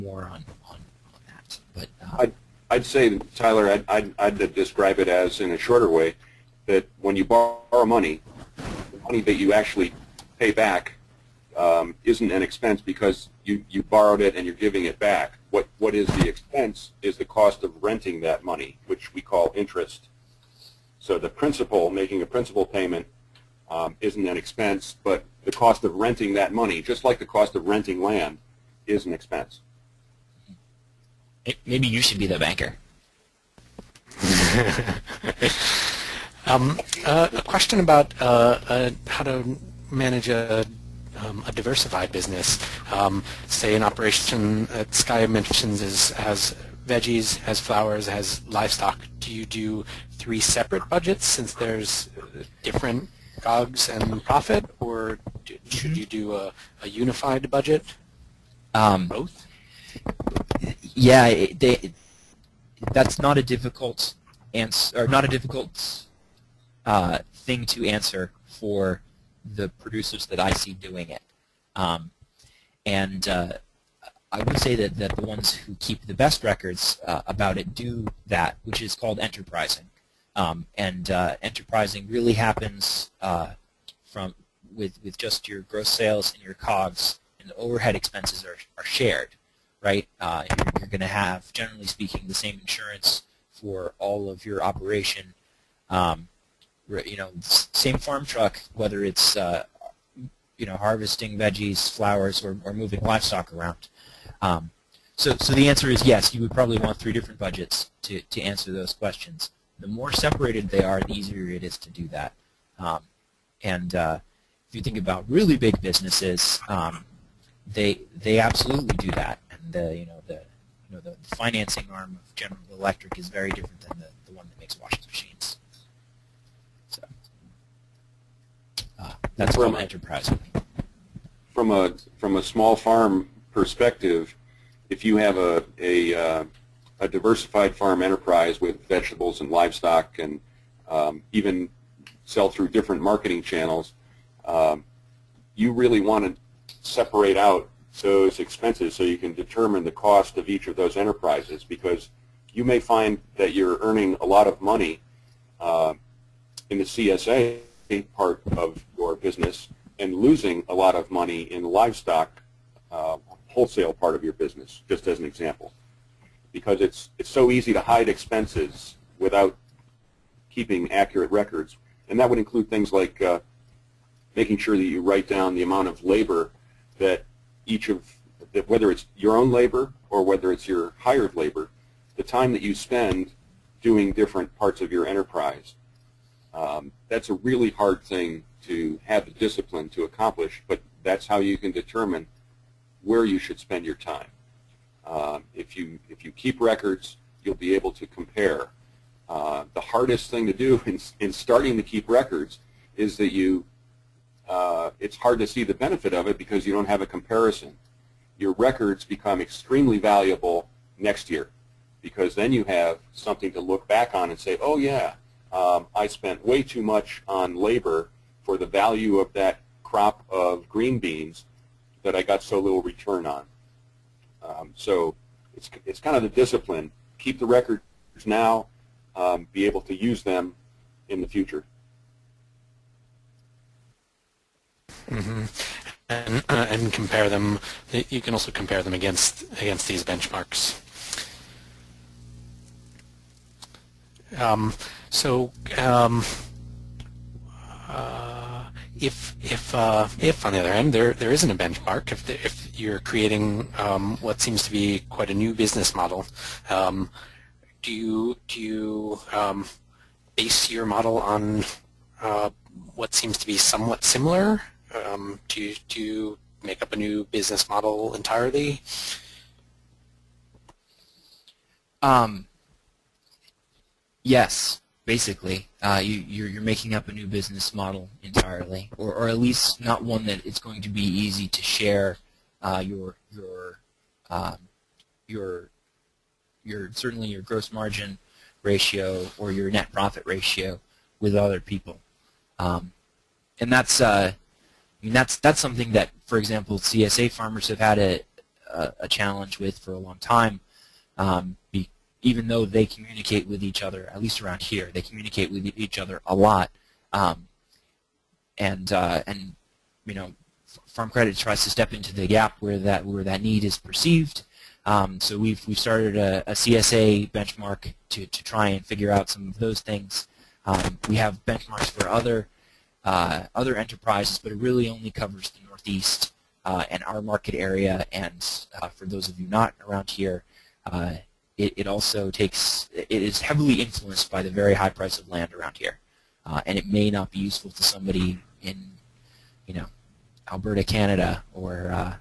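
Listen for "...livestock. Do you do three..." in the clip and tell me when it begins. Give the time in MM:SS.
00:48.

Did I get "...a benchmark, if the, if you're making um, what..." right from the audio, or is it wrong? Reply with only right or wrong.
wrong.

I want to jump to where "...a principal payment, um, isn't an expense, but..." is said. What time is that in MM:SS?
00:22.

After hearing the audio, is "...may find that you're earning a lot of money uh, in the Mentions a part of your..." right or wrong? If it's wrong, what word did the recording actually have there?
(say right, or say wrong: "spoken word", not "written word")
wrong: "CSA", not "Mentions".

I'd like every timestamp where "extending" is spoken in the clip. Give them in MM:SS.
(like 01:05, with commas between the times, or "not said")
not said.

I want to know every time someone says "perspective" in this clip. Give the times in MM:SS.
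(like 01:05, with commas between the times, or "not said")
02:13.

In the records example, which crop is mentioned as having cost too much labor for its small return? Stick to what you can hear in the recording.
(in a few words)
green beans.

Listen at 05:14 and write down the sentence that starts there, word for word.
Um, so we've we've started a, a, CSA benchmark to to try and figure out some of those things.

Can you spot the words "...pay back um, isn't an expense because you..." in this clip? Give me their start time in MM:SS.
00:10.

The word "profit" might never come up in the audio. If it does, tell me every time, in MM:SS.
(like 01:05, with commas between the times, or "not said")
00:54, 04:49.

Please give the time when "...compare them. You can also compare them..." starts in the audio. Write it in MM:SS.
03:56.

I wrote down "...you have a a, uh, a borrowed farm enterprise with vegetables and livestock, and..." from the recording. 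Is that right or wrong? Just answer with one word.
wrong.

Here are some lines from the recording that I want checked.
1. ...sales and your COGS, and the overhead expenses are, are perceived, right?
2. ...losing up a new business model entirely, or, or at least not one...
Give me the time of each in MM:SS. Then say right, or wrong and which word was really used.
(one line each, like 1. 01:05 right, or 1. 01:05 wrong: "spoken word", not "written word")
1. 01:25 wrong: "shared", not "perceived"
2. 04:36 wrong: "making", not "losing".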